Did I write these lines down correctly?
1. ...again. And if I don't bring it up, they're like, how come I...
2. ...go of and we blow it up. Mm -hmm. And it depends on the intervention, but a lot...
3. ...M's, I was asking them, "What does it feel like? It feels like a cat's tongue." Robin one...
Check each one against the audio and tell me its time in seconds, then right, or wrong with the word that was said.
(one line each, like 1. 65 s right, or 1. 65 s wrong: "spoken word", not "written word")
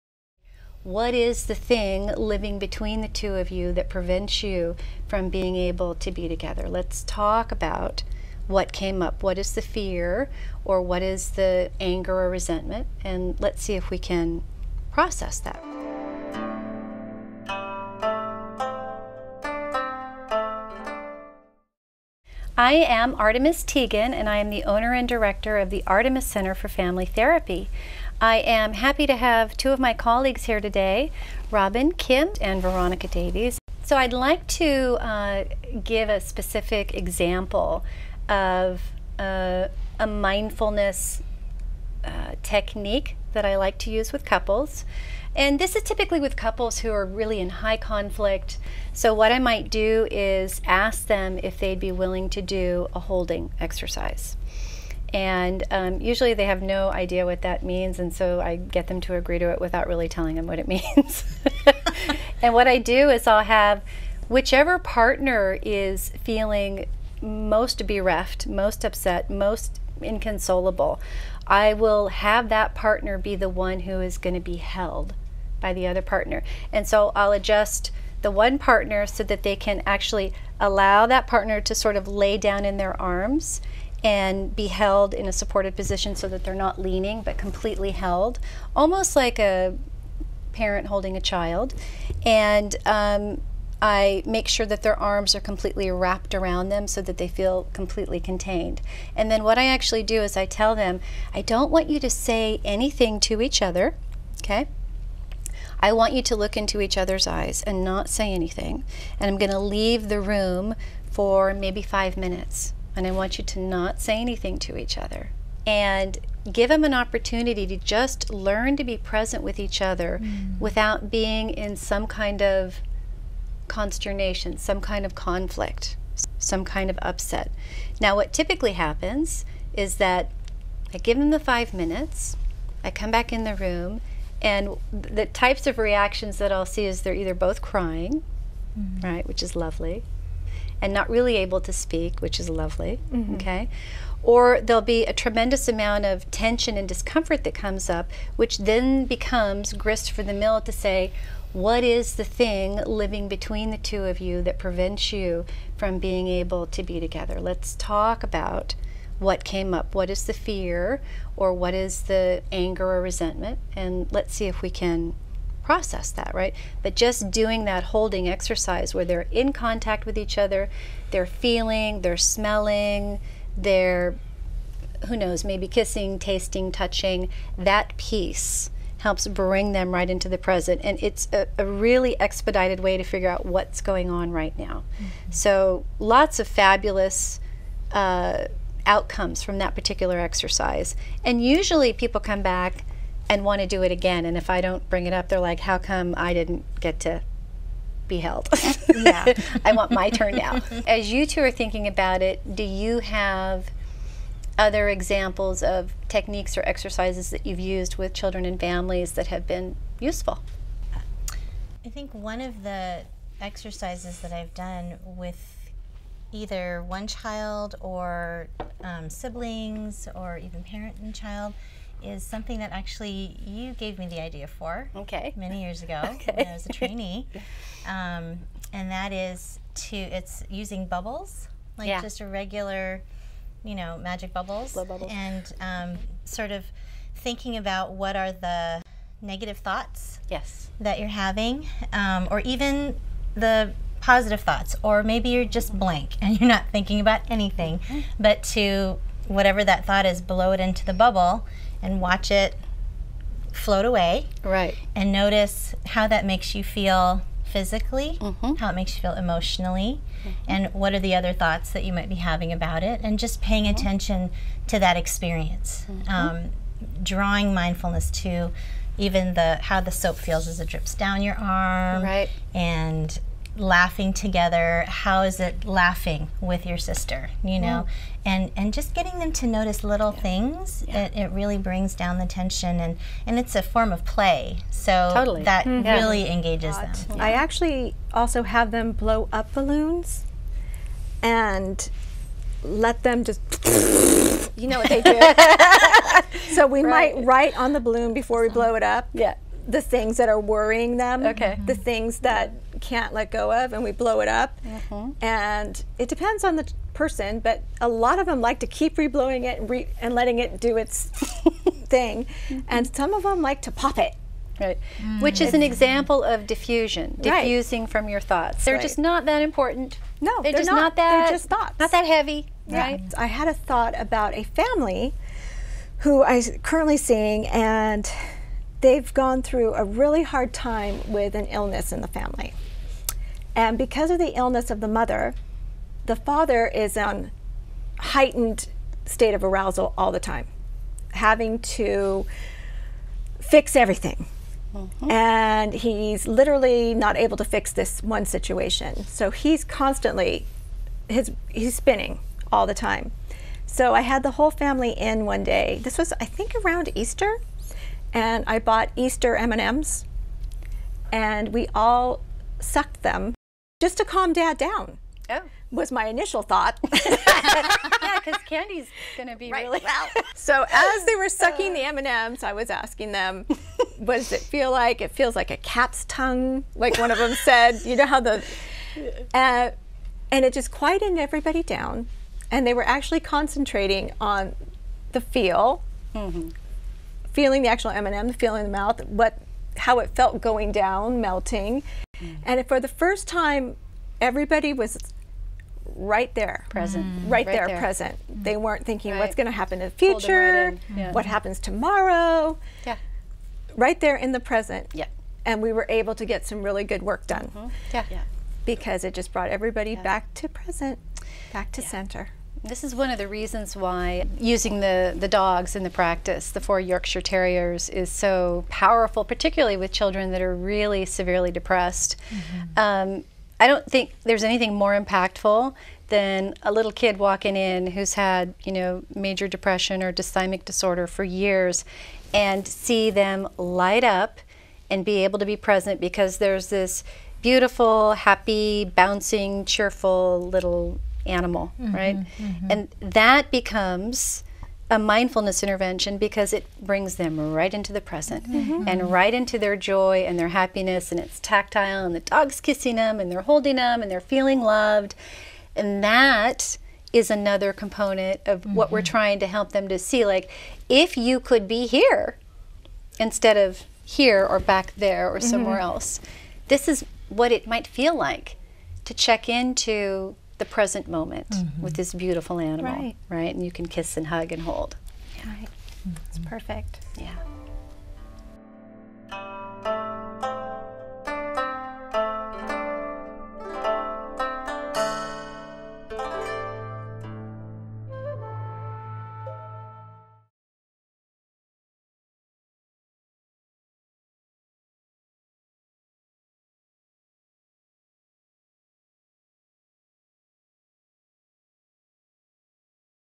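1. 193 s right
2. 303 s wrong: "person", not "intervention"
3. 372 s wrong: "Like", not "Robin".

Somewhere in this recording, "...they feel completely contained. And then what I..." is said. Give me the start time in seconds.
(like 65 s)
97 s.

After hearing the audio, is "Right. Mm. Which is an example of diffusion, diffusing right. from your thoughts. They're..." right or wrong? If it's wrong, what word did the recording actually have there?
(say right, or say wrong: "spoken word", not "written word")
right.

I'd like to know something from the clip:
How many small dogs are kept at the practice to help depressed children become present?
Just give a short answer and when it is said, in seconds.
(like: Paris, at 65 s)
4, at 416 s.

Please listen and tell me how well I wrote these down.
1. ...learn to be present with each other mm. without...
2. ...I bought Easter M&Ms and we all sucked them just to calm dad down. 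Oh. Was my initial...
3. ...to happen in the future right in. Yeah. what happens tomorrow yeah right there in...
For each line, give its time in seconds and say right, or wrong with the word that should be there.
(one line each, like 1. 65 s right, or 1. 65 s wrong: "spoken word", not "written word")
1. 118 s right
2. 358 s right
3. 399 s right.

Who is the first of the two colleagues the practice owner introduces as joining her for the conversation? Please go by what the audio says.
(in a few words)
Robin Kim.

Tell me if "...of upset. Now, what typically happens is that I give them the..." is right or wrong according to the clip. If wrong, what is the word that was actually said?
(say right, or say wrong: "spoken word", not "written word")
right.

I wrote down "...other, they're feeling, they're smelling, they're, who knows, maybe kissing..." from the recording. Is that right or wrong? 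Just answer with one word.
right.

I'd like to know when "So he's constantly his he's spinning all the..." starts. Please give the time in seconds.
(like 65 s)
349 s.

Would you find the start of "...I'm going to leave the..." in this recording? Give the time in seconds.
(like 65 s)
109 s.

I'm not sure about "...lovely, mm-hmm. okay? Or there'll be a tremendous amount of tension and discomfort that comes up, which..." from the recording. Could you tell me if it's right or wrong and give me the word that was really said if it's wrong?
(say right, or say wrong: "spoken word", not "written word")
right.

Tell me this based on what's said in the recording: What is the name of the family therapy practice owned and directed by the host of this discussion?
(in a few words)
Artemis Center for Family Therapy.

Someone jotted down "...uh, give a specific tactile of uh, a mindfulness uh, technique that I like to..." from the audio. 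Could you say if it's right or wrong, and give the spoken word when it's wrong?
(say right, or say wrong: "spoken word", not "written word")
wrong: "example", not "tactile".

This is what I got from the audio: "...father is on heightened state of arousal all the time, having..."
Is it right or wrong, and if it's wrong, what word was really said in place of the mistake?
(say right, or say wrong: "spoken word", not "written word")
right.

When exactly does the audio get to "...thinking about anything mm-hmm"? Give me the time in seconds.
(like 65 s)
246 s.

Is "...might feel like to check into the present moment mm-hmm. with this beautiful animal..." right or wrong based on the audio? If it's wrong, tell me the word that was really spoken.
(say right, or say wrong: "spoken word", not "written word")
right.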